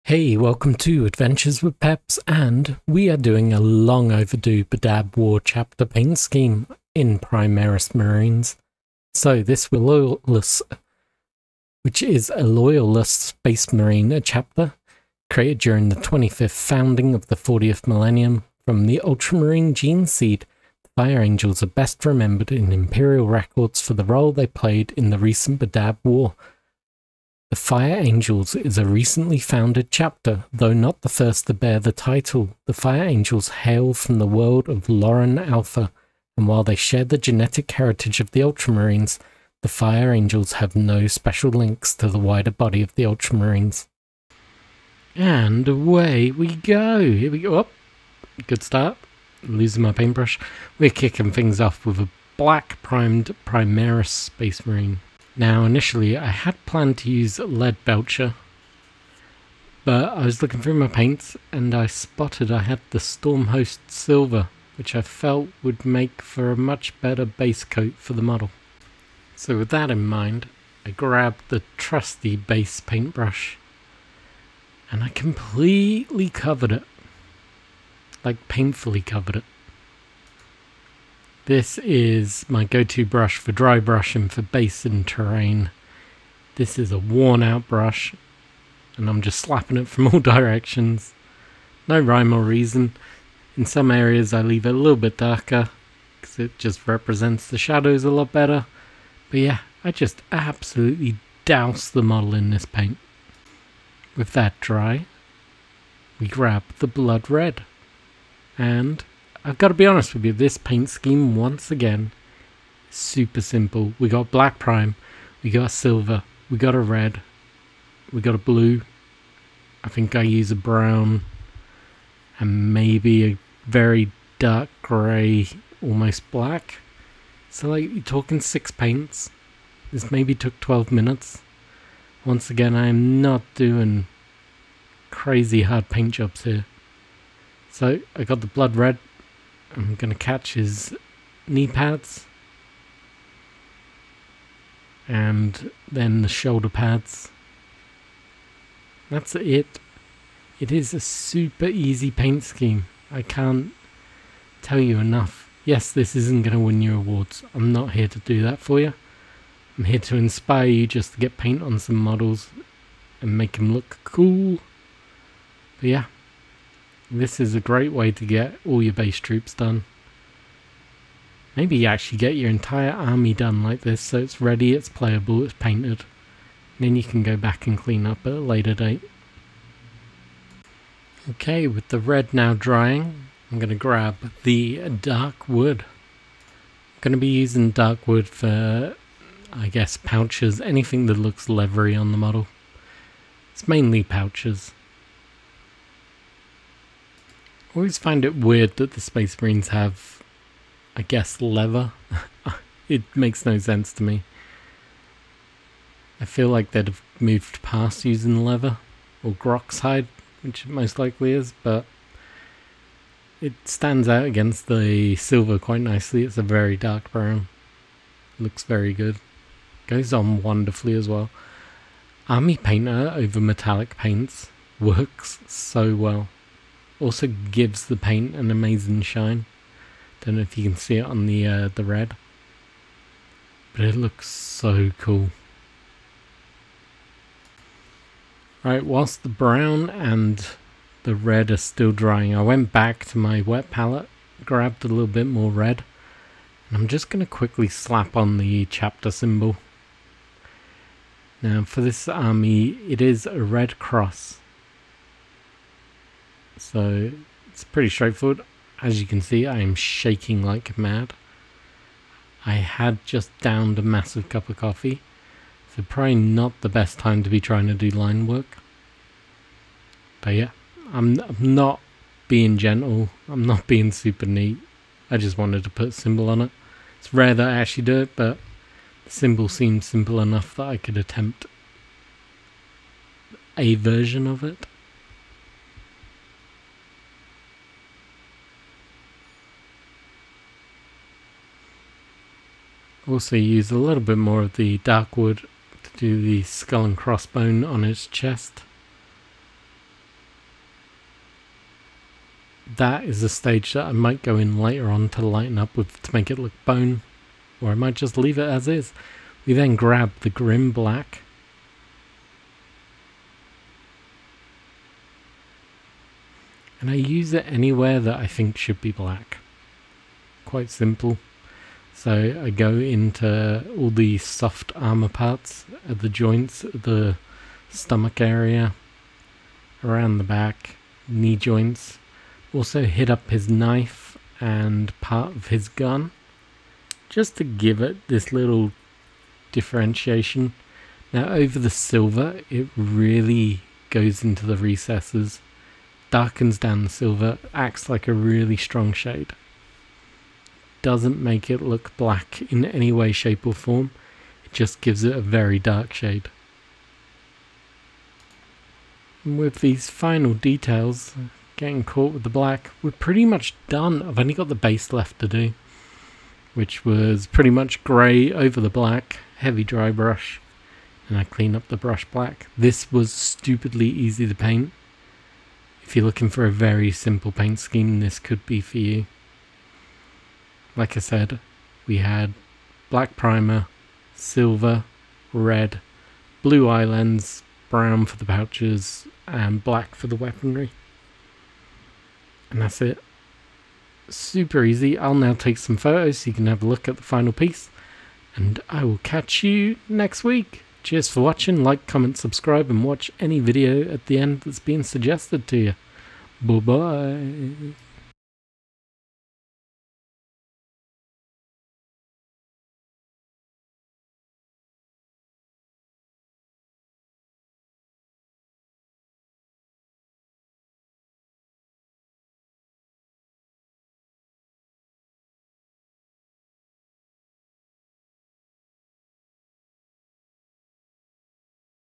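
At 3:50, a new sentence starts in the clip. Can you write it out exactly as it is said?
Don't know if you can see it on the uh, the red, but it looks so cool.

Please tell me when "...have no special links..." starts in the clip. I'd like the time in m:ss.
0:40.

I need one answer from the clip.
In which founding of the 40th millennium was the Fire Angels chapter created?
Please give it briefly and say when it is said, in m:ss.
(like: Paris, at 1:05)
25th founding, at 0:15.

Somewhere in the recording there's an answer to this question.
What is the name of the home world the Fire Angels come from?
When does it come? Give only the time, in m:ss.
0:34.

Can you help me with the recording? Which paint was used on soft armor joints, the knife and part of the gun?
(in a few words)
Grim Black.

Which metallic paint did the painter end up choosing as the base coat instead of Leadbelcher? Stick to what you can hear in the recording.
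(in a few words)
Stormhost Silver.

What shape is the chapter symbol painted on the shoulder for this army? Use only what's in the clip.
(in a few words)
red cross.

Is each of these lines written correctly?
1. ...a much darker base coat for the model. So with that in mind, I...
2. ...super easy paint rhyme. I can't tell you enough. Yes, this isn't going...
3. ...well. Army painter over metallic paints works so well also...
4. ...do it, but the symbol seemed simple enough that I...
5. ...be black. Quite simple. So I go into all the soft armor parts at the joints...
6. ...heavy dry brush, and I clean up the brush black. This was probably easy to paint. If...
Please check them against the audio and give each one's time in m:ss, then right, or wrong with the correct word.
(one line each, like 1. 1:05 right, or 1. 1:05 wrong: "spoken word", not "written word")
1. 1:06 wrong: "better", not "darker"
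2. 2:30 wrong: "scheme", not "rhyme"
3. 3:41 right
4. 4:37 right
5. 5:18 right
6. 6:09 wrong: "stupidly", not "probably".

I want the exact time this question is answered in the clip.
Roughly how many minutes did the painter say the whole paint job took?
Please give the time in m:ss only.
2:10.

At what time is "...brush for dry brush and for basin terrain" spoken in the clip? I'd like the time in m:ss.
1:23.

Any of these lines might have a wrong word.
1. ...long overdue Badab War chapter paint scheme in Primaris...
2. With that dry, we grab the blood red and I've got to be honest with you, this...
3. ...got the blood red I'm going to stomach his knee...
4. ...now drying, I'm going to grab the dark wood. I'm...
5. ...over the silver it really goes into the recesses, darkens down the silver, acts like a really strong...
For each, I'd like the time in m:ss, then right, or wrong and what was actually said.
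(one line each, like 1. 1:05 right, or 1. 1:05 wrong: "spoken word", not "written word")
1. 0:03 right
2. 1:44 right
3. 2:18 wrong: "catch", not "stomach"
4. 3:02 right
5. 5:41 right.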